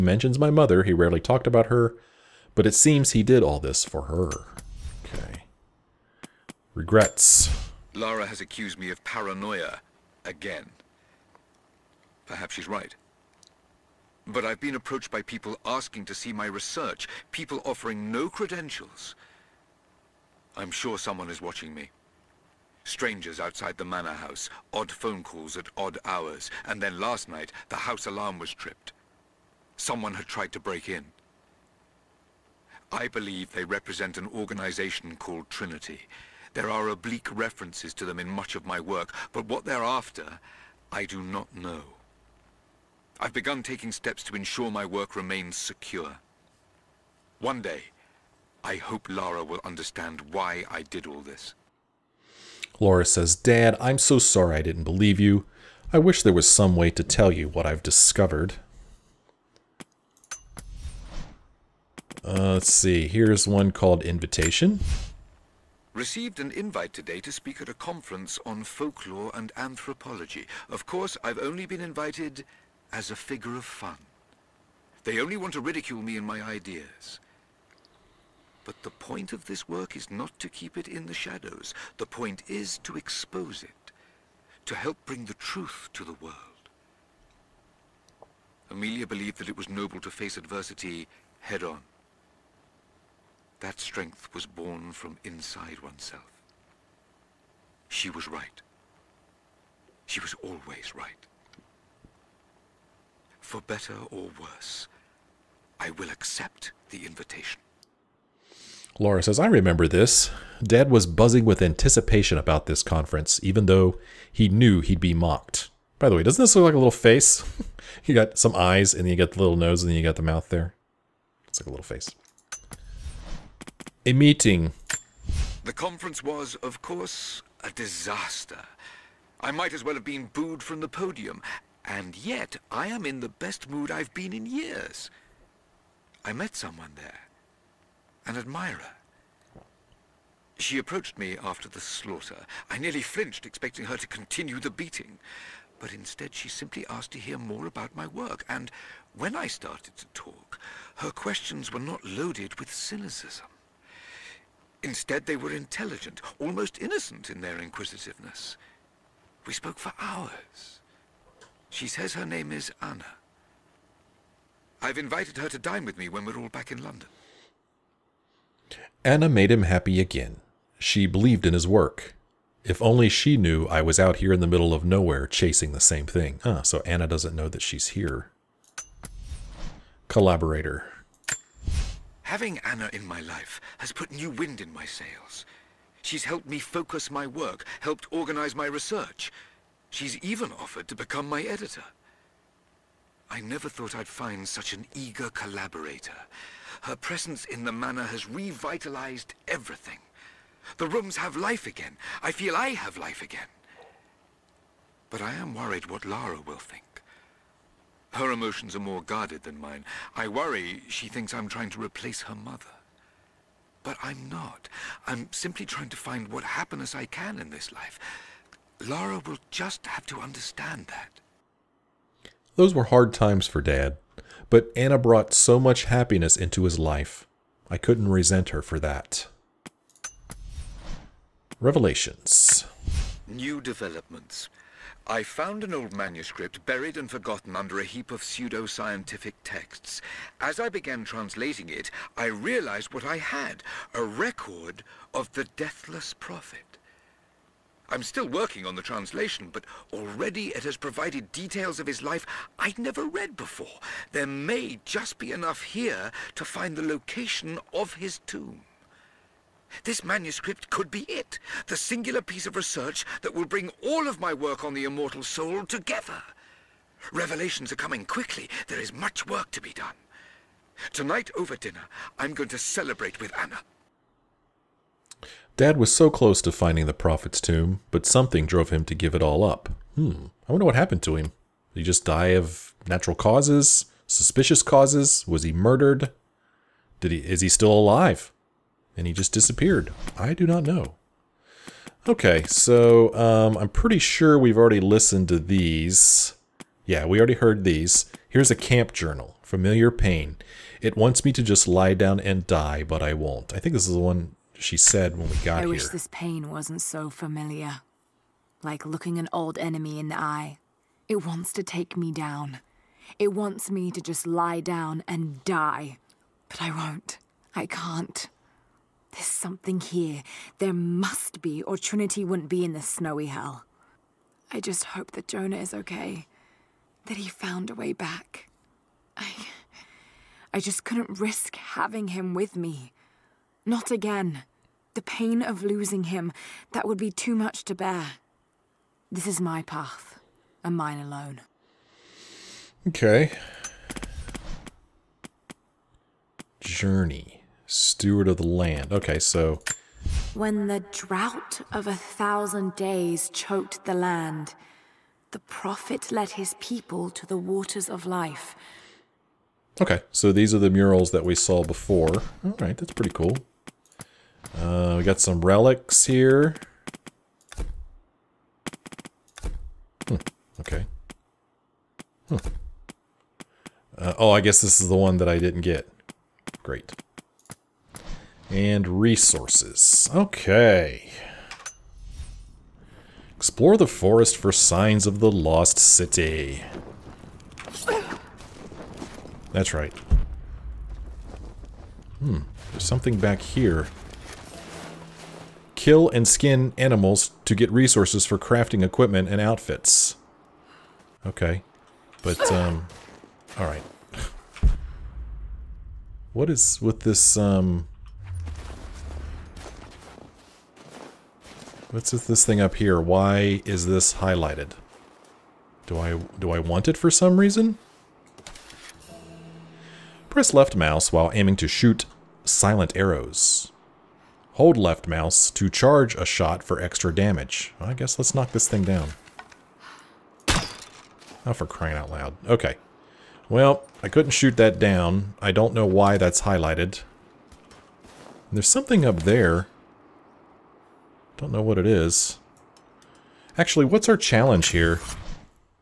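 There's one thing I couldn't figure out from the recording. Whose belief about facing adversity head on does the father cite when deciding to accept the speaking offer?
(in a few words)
Amelia.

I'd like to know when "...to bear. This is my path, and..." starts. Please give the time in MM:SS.
05:37.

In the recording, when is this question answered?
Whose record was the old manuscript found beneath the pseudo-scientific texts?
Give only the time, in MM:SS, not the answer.
04:05.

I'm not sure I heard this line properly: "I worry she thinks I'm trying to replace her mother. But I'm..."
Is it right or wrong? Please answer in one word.
right.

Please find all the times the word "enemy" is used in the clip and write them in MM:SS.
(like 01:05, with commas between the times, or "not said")
05:09.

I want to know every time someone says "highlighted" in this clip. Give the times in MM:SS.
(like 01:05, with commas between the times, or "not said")
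06:54, 07:16.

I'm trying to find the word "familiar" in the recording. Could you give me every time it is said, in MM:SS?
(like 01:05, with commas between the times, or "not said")
04:59, 05:07.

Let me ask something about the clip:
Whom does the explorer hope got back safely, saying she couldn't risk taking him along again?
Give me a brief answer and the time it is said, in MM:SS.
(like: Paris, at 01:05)
Jonah, at 05:25.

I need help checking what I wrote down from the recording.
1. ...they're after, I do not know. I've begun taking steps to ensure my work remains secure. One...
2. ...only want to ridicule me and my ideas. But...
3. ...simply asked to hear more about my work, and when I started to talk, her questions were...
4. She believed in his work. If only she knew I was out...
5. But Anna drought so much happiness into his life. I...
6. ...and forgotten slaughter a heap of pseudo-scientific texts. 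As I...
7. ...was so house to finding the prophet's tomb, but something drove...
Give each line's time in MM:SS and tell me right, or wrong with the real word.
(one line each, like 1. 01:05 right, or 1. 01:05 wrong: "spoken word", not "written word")
1. 00:39 right
2. 01:15 right
3. 02:26 right
4. 02:50 right
5. 03:44 wrong: "brought", not "drought"
6. 03:56 wrong: "under", not "slaughter"
7. 04:35 wrong: "close", not "house".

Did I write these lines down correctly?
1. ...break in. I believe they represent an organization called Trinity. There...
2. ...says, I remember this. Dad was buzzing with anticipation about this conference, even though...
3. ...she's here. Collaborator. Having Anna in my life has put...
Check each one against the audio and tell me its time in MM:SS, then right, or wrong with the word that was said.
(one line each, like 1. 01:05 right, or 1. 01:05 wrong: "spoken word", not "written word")
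1. 00:30 right
2. 01:49 right
3. 02:57 right.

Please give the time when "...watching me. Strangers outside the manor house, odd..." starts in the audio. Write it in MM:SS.
00:21.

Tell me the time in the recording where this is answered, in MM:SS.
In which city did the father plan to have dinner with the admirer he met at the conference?
02:46.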